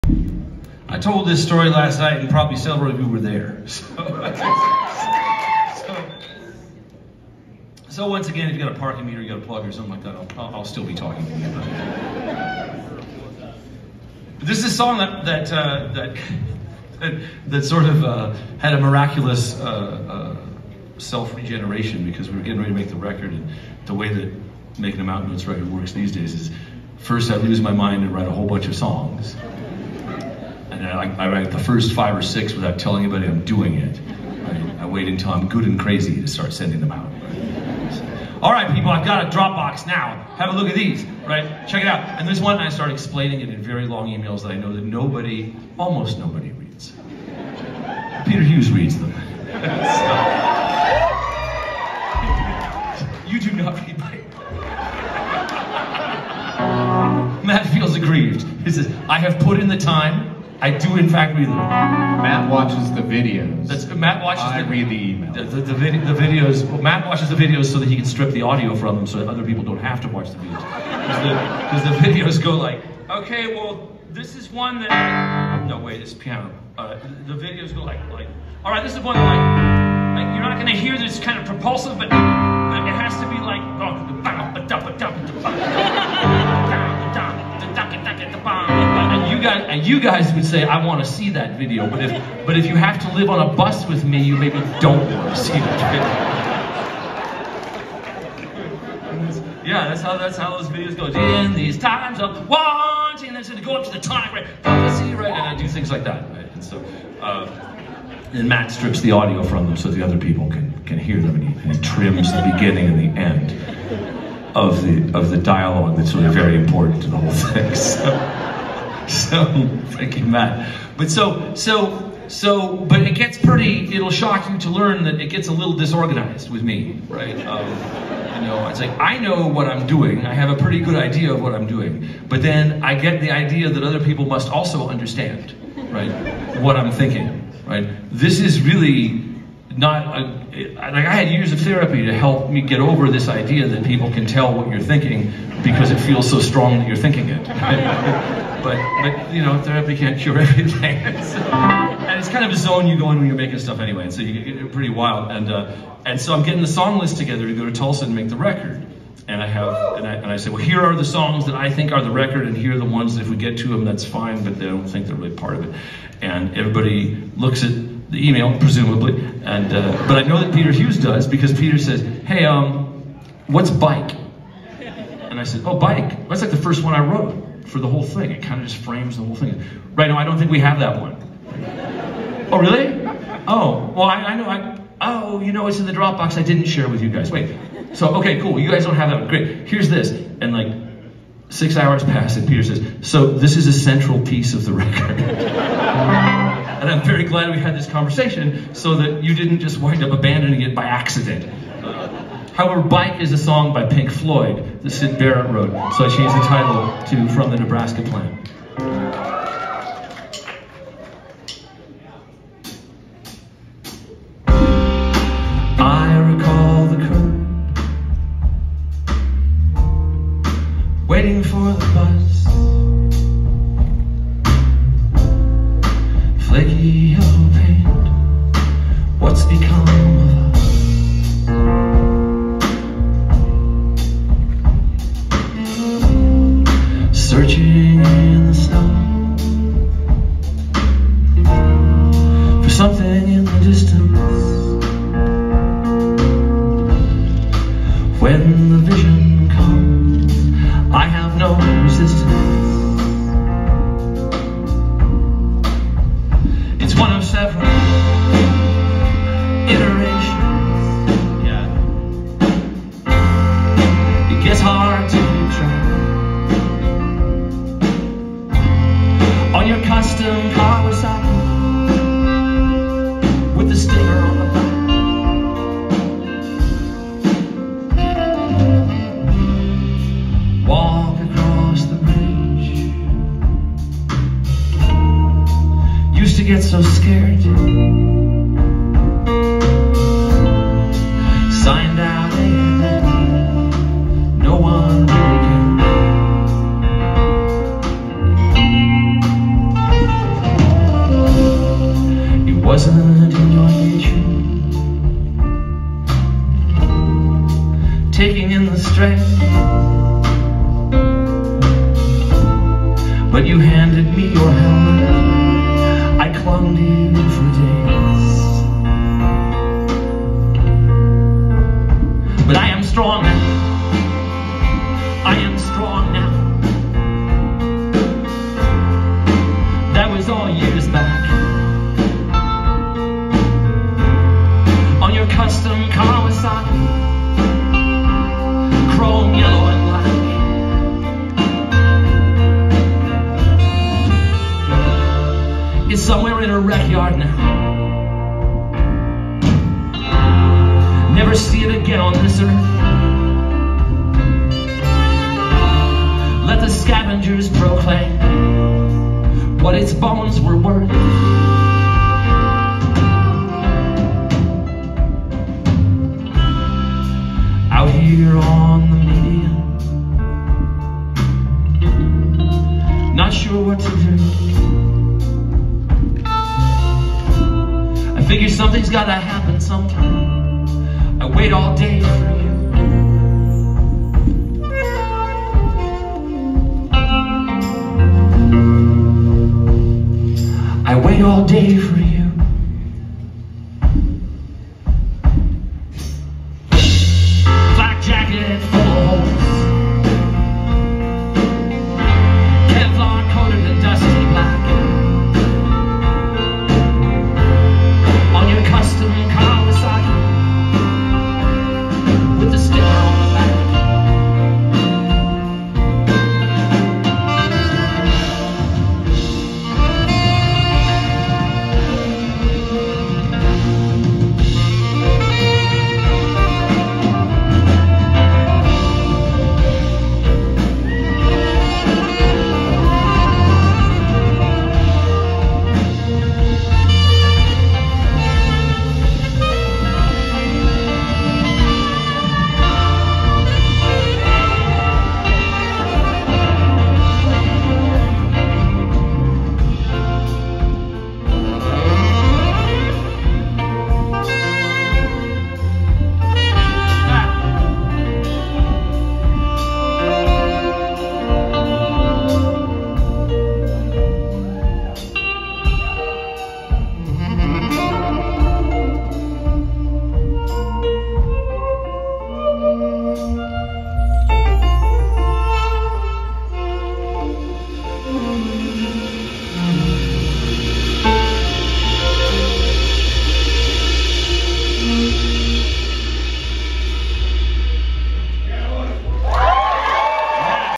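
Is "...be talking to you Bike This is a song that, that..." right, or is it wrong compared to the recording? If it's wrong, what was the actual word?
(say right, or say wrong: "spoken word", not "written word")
wrong: "But", not "Bike".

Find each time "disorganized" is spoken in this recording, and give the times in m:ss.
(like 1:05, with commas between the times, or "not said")
2:05.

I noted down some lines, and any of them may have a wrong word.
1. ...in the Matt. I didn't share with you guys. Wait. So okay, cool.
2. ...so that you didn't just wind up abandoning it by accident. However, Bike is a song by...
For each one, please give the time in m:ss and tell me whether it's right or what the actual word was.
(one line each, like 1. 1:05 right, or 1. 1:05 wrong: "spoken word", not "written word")
1. 3:05 wrong: "Dropbox", not "Matt"
2. 3:18 right.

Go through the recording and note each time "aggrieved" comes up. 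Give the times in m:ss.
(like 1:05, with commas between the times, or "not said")
0:57.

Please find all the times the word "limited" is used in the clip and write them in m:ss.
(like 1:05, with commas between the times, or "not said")
not said.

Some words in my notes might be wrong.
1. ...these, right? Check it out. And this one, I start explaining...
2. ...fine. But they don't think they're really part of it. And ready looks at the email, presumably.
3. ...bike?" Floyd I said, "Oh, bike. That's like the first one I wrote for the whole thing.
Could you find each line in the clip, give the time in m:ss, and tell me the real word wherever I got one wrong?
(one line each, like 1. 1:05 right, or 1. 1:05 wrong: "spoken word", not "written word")
1. 0:40 right
2. 2:44 wrong: "everybody", not "ready"
3. 2:53 wrong: "And", not "Floyd".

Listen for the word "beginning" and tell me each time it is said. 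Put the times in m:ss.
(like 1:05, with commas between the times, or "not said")
1:52.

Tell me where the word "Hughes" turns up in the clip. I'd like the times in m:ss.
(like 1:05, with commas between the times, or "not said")
0:48, 2:50.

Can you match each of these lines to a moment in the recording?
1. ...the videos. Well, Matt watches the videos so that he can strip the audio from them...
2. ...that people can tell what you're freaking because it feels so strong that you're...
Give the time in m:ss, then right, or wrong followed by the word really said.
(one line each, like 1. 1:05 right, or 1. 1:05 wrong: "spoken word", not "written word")
1. 1:06 right
2. 2:23 wrong: "thinking", not "freaking".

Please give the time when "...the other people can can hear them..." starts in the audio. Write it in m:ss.
1:49.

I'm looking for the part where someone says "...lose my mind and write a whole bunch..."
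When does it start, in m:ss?
0:27.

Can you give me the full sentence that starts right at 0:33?
I, I wait until I'm good and crazy to start sending them out.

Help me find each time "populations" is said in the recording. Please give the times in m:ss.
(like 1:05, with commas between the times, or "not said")
not said.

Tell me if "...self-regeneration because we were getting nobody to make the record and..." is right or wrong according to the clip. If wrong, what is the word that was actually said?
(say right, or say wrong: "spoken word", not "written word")
wrong: "ready", not "nobody".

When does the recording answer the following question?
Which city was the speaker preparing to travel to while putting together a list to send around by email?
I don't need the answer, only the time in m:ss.
2:37.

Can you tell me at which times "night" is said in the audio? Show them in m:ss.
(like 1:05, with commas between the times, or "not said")
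0:01.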